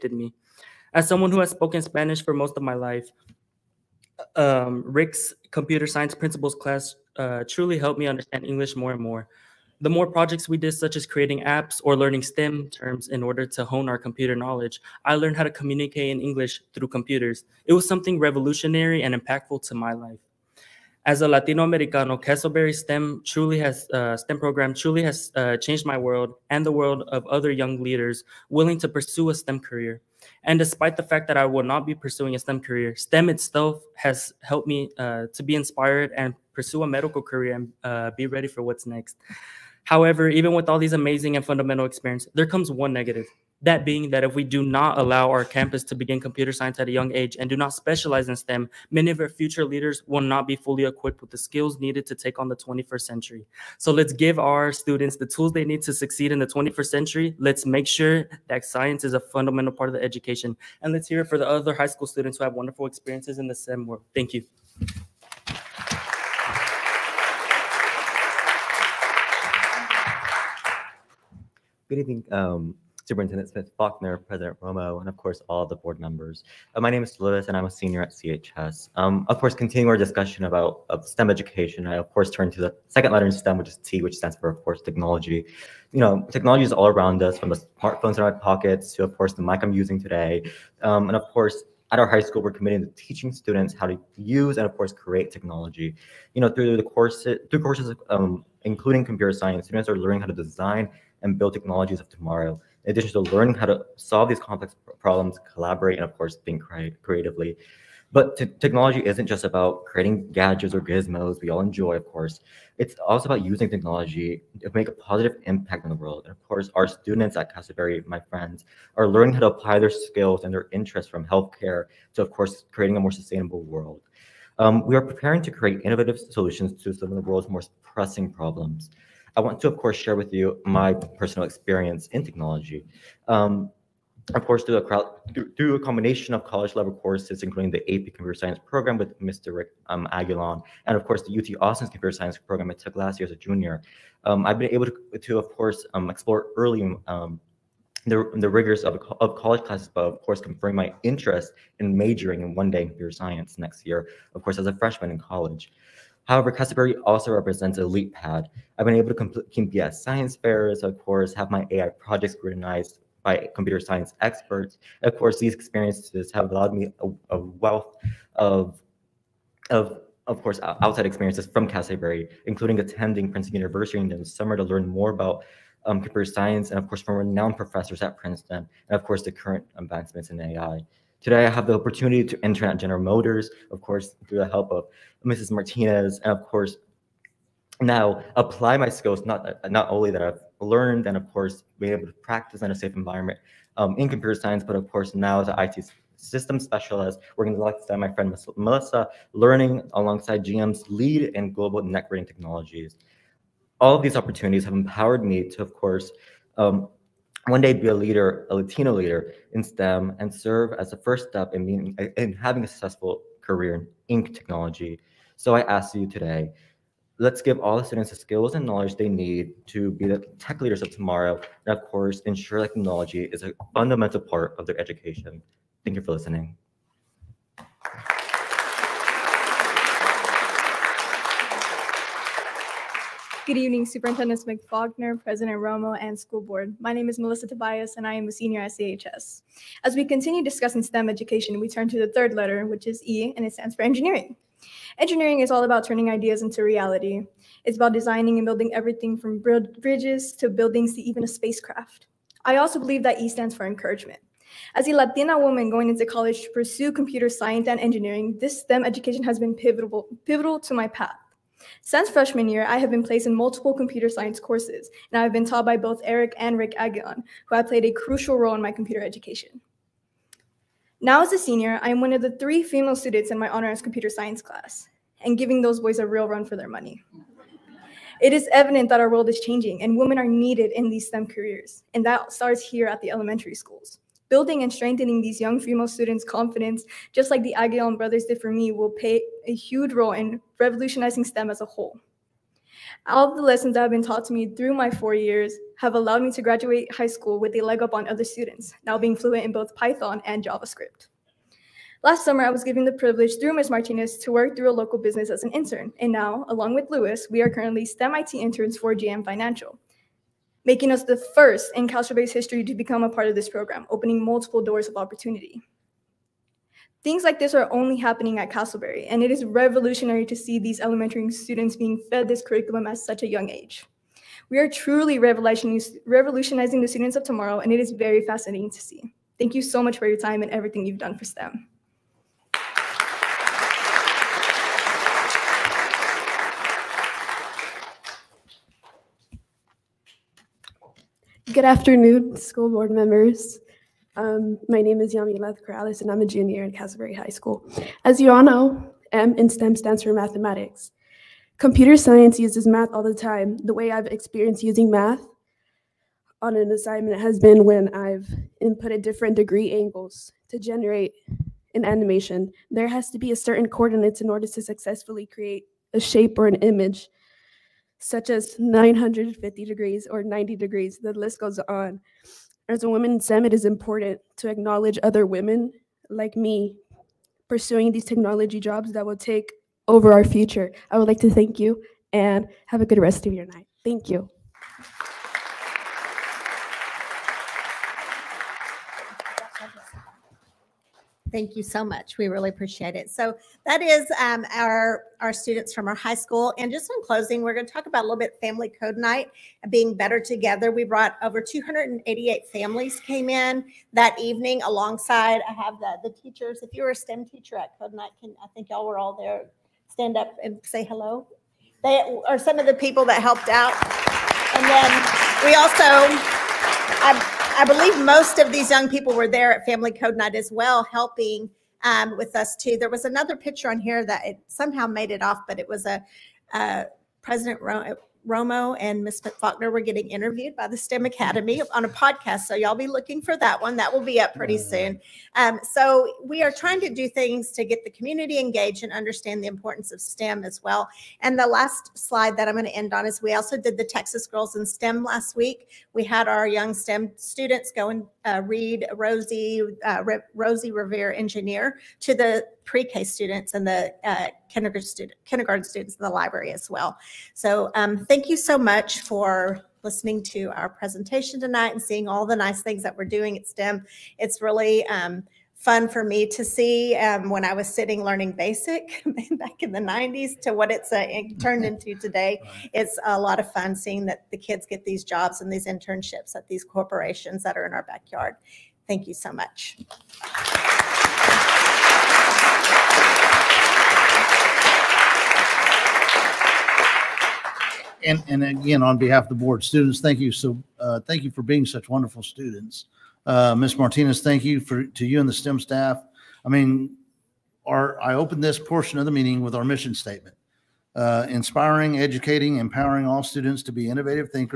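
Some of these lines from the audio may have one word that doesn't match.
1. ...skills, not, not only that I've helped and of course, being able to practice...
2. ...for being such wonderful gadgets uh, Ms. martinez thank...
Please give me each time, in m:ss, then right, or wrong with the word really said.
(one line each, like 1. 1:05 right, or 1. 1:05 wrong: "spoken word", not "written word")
1. 3:08 wrong: "learned", not "helped"
2. 8:11 wrong: "students", not "gadgets".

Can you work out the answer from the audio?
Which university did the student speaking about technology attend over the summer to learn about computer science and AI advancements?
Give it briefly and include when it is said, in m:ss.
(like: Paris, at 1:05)
Princeton University, at 2:53.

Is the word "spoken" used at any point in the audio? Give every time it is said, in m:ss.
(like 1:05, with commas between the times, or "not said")
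0:01.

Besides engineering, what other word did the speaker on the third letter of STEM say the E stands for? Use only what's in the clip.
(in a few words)
encouragement.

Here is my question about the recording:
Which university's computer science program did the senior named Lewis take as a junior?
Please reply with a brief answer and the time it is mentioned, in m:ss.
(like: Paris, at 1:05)
UT Austin, at 2:21.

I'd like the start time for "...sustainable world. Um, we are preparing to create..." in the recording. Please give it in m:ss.
2:03.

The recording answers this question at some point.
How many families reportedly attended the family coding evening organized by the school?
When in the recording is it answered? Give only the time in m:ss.
6:41.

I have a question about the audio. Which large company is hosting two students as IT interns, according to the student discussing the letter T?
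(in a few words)
General Motors.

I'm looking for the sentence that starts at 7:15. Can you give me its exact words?
Um, so we are trying to do things to get the community engaged and understand the importance of STEM as well.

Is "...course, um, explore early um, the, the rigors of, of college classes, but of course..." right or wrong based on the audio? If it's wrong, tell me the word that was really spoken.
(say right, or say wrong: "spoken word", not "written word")
right.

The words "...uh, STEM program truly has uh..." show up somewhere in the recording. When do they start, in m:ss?
0:23.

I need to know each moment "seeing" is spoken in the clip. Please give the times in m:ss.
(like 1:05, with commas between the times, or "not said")
7:41, 7:53.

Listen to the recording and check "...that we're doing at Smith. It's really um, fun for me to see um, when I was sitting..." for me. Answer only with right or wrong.
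wrong.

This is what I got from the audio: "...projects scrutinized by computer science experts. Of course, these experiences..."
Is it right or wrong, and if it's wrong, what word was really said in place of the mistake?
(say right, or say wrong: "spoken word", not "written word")
right.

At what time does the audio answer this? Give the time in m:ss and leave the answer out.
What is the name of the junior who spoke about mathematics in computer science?
5:45.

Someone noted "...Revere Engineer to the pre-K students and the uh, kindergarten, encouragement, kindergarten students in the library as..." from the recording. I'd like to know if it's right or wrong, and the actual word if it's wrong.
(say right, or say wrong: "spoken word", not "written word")
wrong: "student", not "encouragement".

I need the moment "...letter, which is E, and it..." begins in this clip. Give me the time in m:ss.
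4:02.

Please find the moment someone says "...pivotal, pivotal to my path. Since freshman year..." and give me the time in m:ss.
4:19.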